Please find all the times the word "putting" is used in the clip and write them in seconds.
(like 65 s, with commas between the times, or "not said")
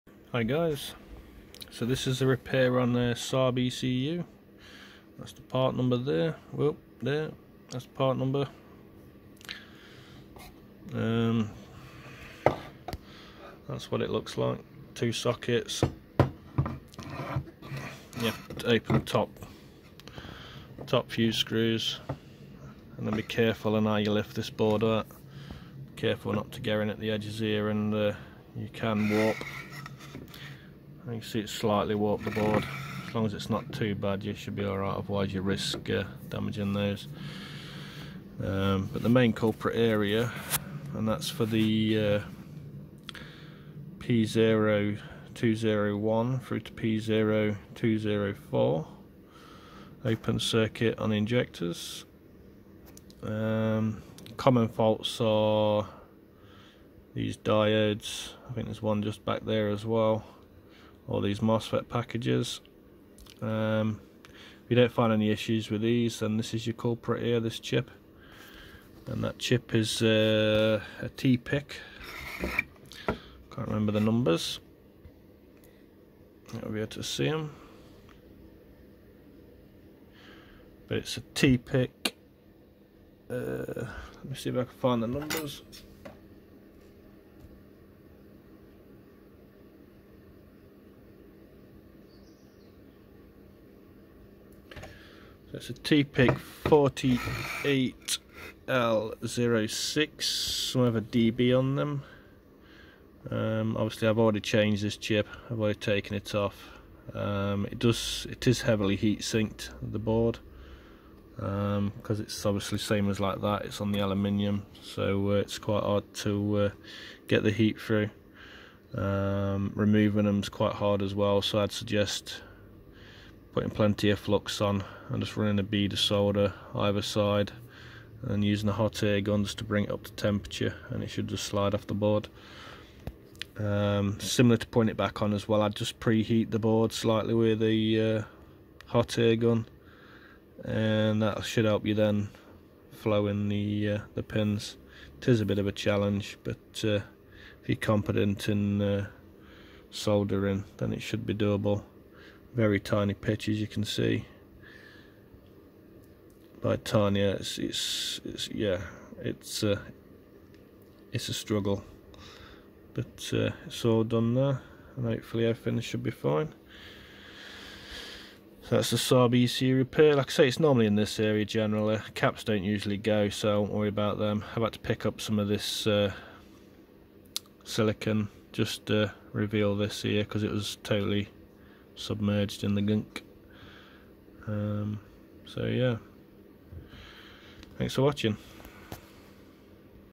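123 s, 134 s.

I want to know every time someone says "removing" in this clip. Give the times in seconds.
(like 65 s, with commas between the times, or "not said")
119 s.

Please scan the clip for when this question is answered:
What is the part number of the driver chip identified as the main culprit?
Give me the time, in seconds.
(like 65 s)
95 s.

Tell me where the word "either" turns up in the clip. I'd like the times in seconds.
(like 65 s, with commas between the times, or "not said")
126 s.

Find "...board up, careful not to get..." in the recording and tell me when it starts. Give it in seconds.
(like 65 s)
24 s.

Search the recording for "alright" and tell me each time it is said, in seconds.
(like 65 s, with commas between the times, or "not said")
34 s.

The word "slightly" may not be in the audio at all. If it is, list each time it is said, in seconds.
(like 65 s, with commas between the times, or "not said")
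31 s, 136 s.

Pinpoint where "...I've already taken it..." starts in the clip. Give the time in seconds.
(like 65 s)
105 s.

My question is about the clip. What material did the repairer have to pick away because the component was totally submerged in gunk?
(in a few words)
Silicon.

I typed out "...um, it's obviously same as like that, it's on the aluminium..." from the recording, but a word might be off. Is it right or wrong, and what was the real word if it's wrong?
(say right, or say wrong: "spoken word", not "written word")
right.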